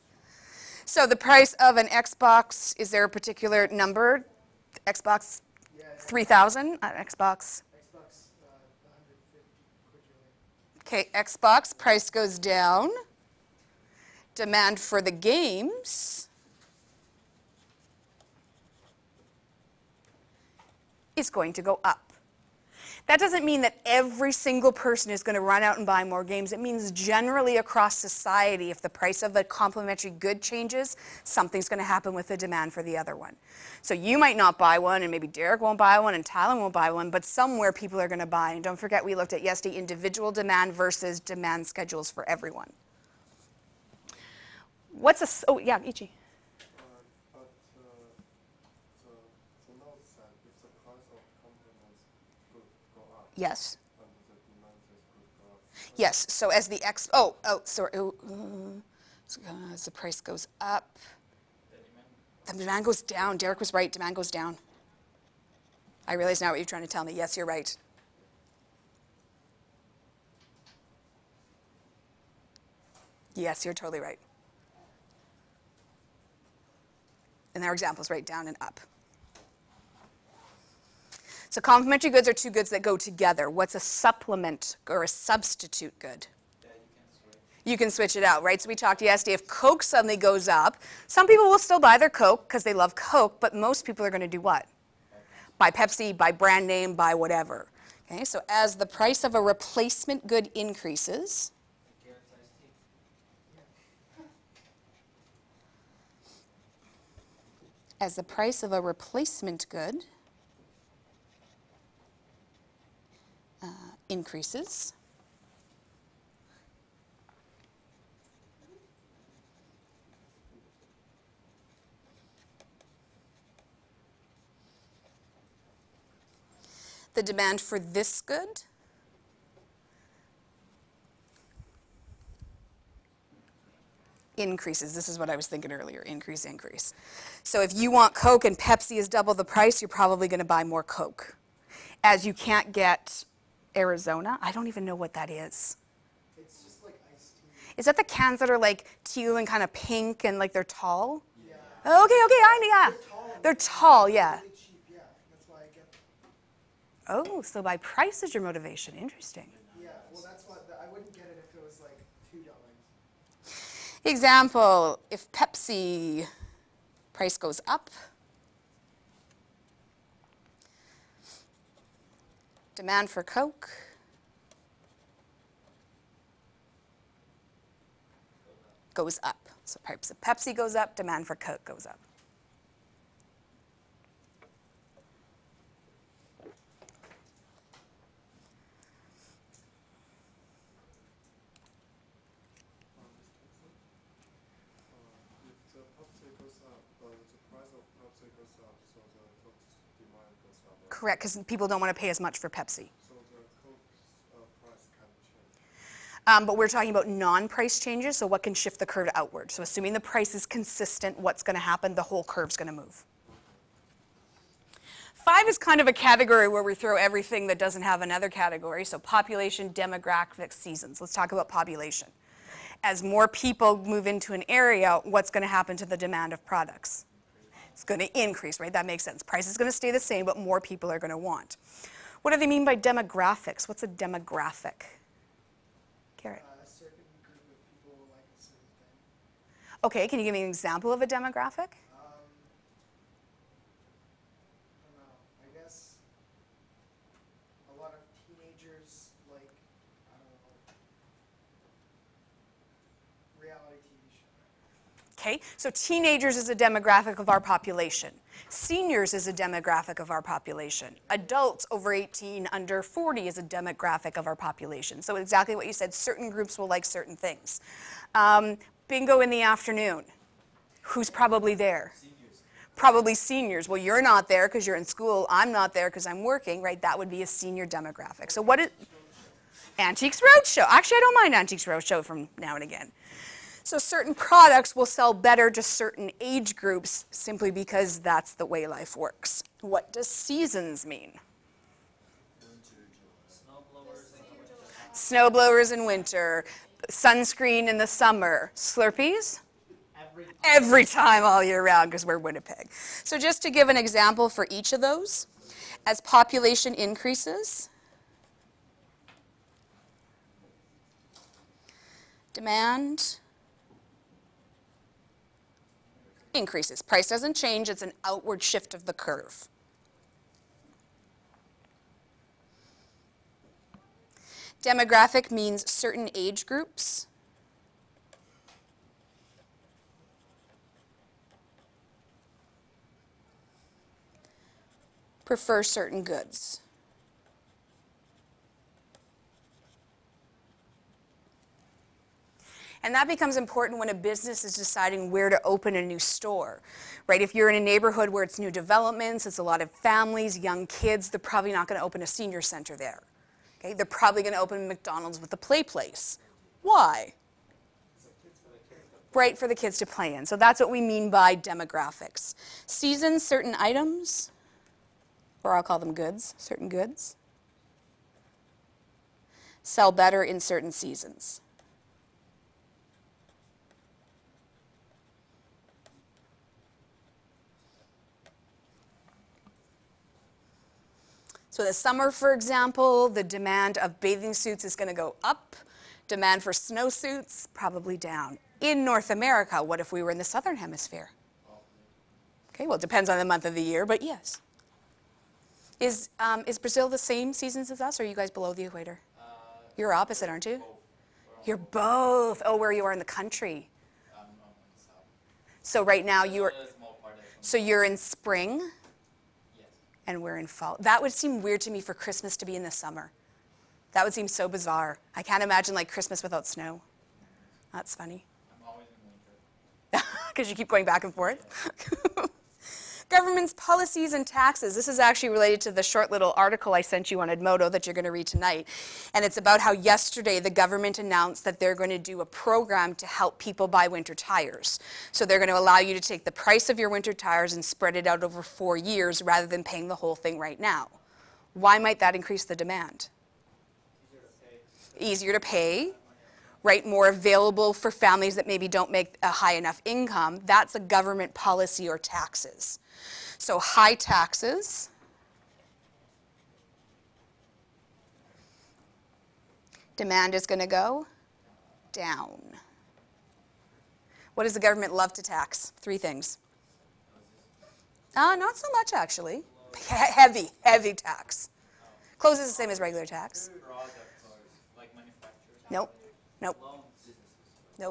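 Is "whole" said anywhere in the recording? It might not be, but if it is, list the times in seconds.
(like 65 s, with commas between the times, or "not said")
212 s, 439 s.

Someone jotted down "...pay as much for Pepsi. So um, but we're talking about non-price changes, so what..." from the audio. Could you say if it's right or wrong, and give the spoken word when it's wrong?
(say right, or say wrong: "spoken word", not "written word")
right.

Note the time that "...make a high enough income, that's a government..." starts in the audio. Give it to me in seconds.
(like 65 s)
448 s.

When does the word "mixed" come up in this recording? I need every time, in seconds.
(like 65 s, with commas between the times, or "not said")
not said.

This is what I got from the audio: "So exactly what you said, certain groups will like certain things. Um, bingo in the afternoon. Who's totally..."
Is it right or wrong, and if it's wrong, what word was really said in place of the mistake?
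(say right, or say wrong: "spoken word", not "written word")
wrong: "probably", not "totally".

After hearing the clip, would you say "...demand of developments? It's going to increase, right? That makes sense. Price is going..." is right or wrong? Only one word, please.
wrong.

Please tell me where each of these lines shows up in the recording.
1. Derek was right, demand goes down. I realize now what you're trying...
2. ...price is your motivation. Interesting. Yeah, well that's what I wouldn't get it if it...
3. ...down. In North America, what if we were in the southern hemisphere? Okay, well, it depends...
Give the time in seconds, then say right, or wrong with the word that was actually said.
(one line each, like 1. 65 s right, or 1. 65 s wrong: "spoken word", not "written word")
1. 63 s right
2. 157 s right
3. 387 s right.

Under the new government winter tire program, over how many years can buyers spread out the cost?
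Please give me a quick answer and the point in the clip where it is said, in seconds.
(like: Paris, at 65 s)
4, at 438 s.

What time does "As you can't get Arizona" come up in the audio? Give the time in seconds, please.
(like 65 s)
142 s.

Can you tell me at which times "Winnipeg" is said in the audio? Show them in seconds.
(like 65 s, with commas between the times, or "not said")
302 s.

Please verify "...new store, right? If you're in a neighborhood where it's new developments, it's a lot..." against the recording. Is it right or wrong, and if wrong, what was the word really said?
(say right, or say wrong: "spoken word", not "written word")
right.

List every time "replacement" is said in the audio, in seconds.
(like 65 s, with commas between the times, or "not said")
99 s, 108 s.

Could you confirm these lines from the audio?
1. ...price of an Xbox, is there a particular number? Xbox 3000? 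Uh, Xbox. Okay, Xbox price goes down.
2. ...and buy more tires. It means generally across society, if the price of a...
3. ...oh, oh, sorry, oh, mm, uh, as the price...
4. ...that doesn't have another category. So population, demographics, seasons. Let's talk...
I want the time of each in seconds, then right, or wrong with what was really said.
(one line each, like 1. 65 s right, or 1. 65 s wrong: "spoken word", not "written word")
1. 1 s right
2. 25 s wrong: "games", not "tires"
3. 57 s right
4. 217 s right.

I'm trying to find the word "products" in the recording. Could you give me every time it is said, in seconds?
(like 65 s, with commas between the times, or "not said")
226 s, 284 s.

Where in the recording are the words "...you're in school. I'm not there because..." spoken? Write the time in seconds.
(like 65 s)
274 s.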